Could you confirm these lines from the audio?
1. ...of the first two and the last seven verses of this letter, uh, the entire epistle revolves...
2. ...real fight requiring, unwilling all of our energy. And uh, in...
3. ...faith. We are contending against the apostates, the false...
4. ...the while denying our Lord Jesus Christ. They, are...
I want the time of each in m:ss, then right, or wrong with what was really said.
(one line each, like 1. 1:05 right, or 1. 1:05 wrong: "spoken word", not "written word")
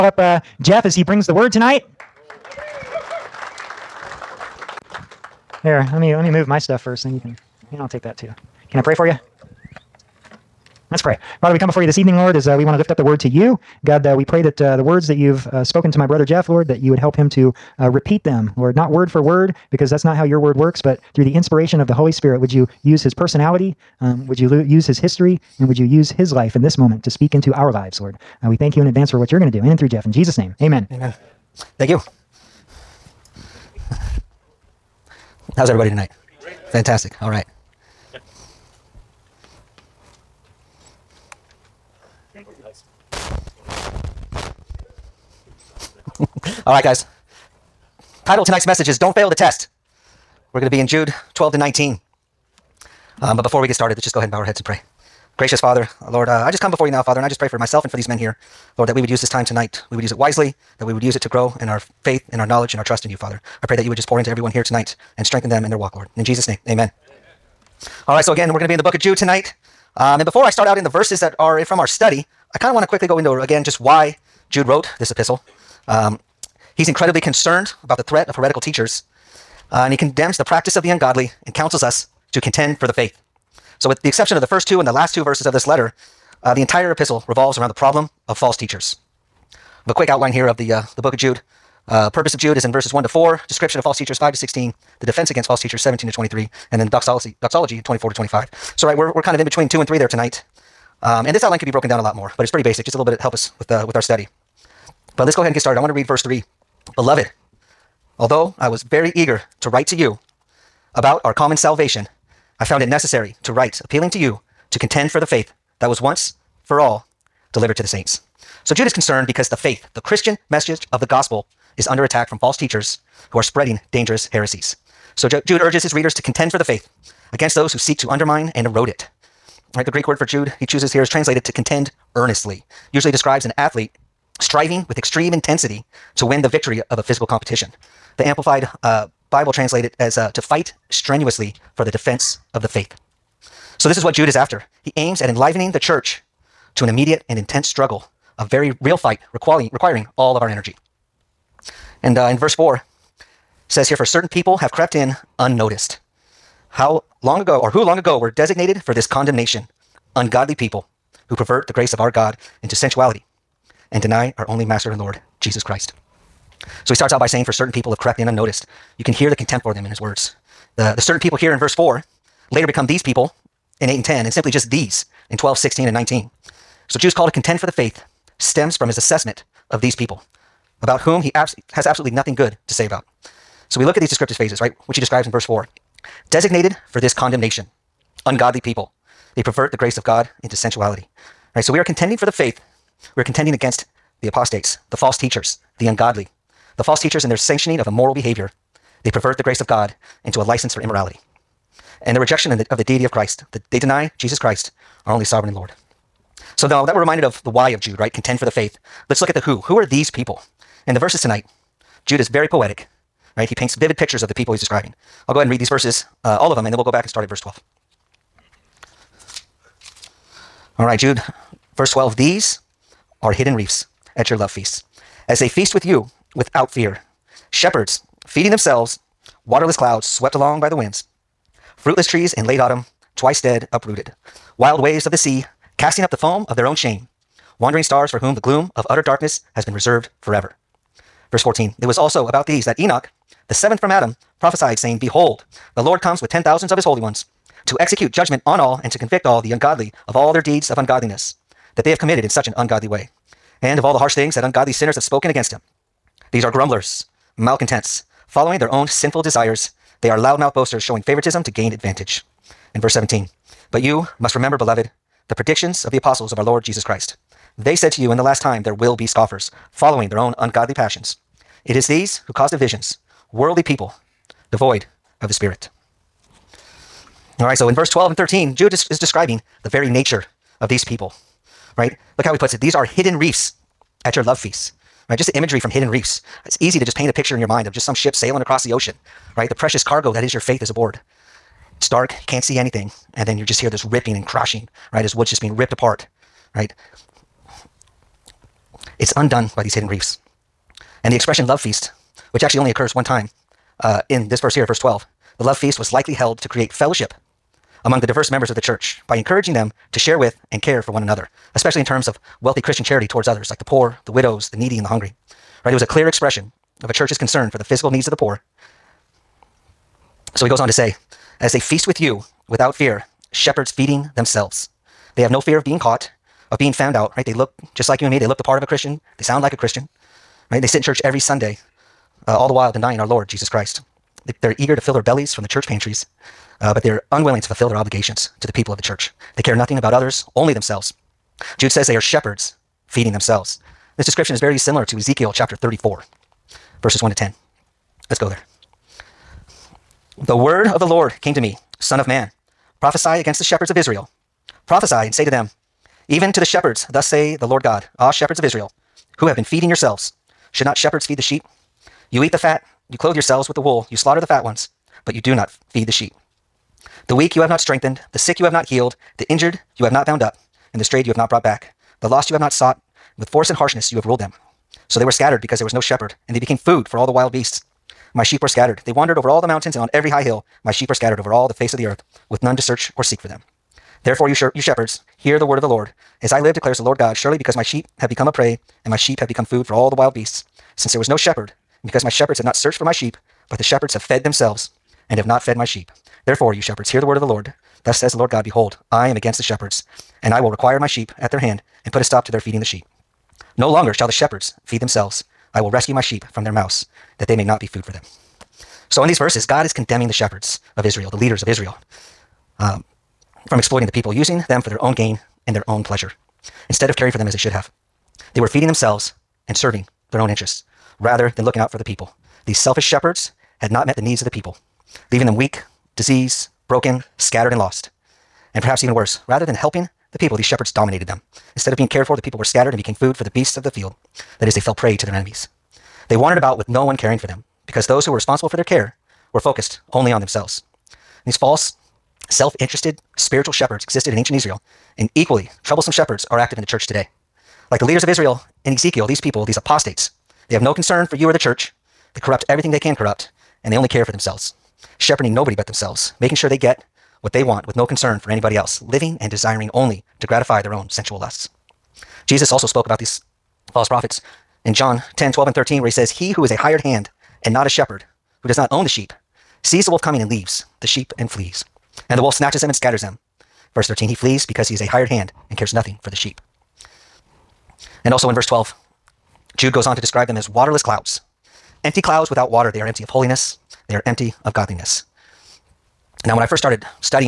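1. 1:24 wrong: "two", not "seven"
2. 2:28 wrong: "requiring", not "unwilling"
3. 3:12 right
4. 5:32 right.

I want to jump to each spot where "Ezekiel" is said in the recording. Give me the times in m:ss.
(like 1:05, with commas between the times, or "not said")
5:44, 7:28.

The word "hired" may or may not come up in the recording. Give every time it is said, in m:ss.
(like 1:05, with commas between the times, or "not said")
7:46, 7:54.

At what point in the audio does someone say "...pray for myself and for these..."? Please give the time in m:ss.
0:57.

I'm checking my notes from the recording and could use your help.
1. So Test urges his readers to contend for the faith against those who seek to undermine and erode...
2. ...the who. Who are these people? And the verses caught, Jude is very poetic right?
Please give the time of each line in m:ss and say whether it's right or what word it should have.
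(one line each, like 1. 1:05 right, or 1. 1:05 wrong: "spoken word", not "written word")
1. 2:05 wrong: "Jude", not "Test"
2. 3:29 wrong: "tonight", not "caught".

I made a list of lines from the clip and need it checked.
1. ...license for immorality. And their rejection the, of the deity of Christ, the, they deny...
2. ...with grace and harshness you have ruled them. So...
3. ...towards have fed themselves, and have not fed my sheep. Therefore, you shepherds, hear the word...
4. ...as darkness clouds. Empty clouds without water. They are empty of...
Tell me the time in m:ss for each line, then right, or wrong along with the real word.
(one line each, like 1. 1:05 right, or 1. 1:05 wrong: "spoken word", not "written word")
1. 3:20 right
2. 6:13 wrong: "force", not "grace"
3. 6:33 wrong: "shepherds", not "towards"
4. 8:00 wrong: "waterless", not "darkness".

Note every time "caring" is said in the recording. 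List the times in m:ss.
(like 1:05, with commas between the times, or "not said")
6:56, 7:16.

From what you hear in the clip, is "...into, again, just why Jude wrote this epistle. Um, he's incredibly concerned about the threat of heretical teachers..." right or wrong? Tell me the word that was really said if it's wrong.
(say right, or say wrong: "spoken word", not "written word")
right.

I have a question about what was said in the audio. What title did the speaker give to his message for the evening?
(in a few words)
Don't Fail the Test.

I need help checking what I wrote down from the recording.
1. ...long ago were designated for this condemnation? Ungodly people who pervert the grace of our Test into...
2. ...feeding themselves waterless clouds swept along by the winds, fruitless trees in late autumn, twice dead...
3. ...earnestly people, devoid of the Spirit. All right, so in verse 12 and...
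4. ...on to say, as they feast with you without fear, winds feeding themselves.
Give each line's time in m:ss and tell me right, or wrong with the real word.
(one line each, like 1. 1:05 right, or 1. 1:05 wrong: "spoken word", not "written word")
1. 2:37 wrong: "God", not "Test"
2. 3:48 right
3. 4:33 wrong: "worldly", not "earnestly"
4. 5:20 wrong: "shepherds", not "winds".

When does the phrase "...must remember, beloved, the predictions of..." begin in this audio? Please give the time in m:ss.
4:24.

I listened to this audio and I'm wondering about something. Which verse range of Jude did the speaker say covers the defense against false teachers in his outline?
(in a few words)
17 to 23.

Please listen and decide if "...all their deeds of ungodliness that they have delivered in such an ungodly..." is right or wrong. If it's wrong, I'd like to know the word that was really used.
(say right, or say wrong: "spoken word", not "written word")
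wrong: "committed", not "delivered".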